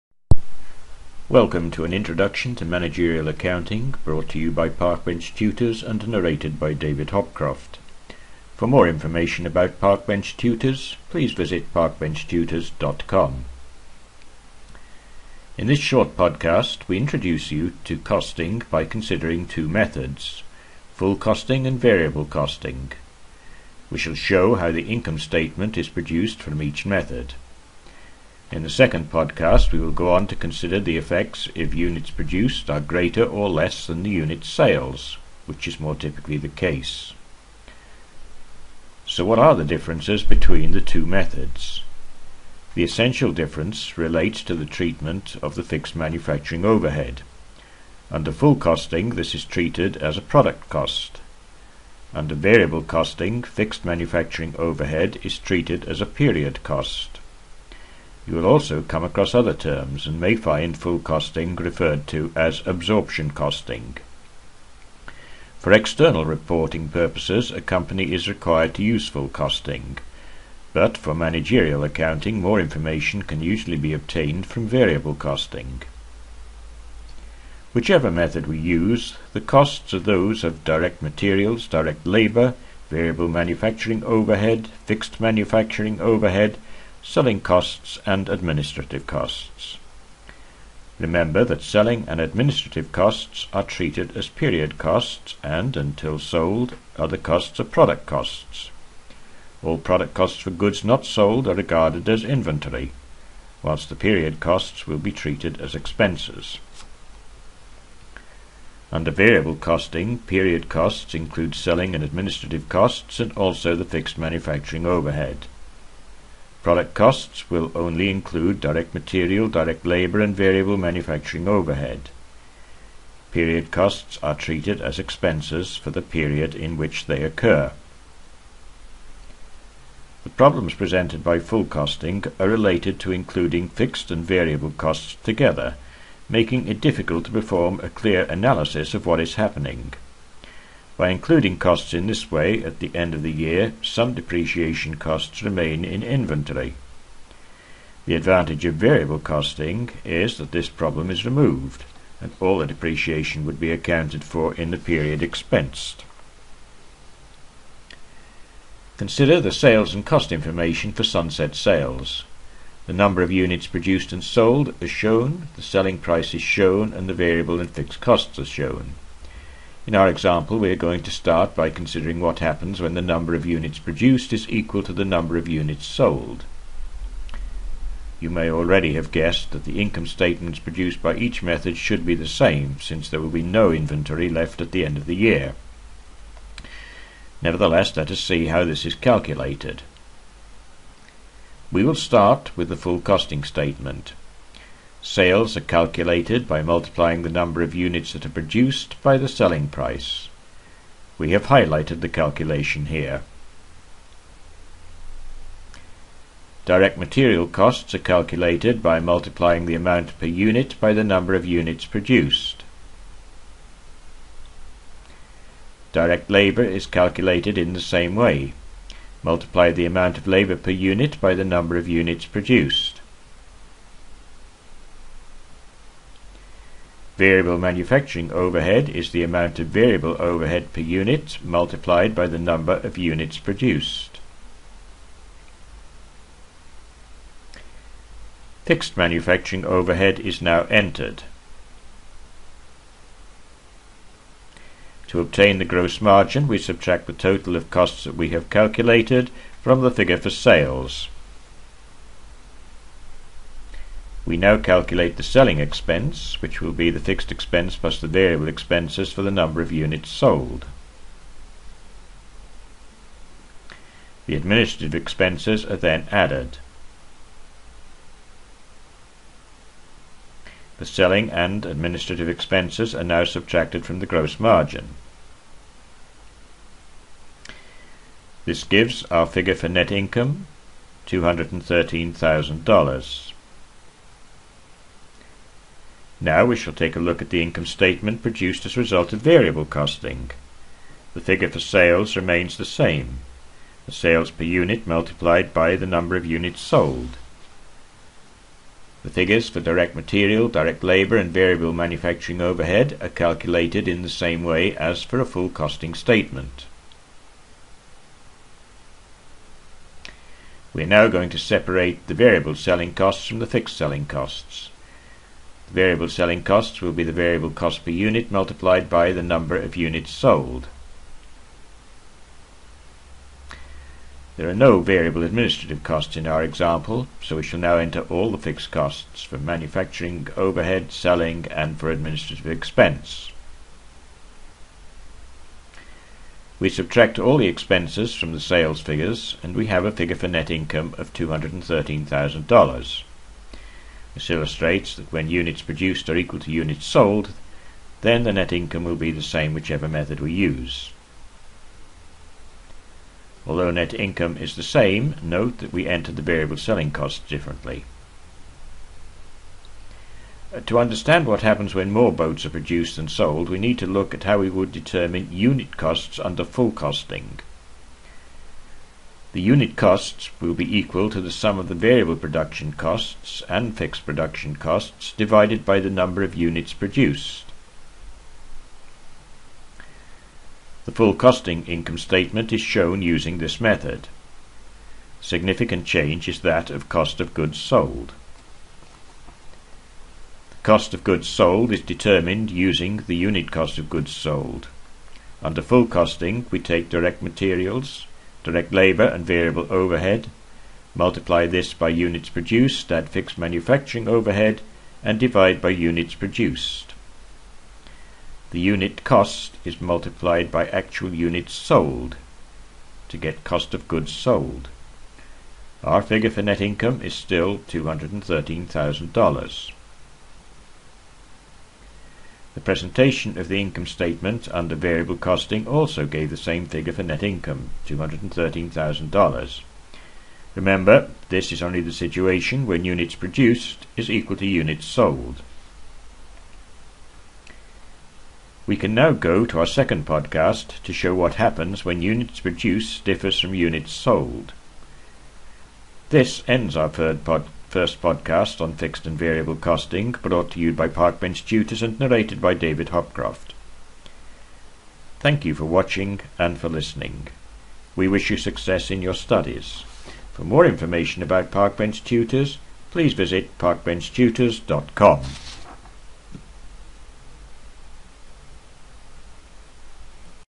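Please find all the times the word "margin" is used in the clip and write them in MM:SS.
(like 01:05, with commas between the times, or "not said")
04:06, 04:34.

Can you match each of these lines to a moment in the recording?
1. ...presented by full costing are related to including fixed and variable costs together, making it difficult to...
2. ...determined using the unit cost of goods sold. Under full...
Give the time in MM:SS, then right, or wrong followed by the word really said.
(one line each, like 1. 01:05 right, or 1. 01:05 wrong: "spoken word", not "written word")
1. 02:10 right
2. 06:31 right.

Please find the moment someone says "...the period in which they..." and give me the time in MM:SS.
02:05.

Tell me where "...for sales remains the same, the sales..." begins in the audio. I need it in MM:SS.
04:51.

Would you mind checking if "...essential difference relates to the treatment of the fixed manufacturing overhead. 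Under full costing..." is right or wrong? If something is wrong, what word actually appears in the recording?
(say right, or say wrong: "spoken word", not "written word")
right.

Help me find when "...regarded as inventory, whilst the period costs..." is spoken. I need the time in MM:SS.
01:41.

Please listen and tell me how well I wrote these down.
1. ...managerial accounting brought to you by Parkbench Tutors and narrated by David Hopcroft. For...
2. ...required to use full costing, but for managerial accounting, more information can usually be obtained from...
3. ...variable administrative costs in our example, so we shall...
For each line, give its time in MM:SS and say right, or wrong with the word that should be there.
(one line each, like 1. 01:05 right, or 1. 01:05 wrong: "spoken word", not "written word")
1. 00:02 right
2. 01:08 right
3. 05:24 right.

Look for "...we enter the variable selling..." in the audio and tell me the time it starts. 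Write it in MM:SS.
05:55.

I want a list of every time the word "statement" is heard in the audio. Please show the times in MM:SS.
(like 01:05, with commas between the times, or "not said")
00:25, 03:00, 03:13, 04:47, 05:05, 06:21, 07:03.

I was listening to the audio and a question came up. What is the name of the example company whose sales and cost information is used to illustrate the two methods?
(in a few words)
Sunset Sales.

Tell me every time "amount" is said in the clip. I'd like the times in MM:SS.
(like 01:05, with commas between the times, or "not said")
03:29, 03:39, 03:49.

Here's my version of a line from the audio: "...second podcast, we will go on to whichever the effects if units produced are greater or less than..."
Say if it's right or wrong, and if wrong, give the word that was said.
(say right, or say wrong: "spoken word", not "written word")
wrong: "consider", not "whichever".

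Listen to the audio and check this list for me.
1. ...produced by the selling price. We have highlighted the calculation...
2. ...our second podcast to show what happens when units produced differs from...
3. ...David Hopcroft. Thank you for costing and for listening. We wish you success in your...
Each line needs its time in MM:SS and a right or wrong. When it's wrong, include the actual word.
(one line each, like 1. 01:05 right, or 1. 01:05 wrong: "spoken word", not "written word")
1. 03:18 right
2. 07:19 right
3. 07:32 wrong: "watching", not "costing".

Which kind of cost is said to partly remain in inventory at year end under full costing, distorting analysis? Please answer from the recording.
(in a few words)
Depreciation costs.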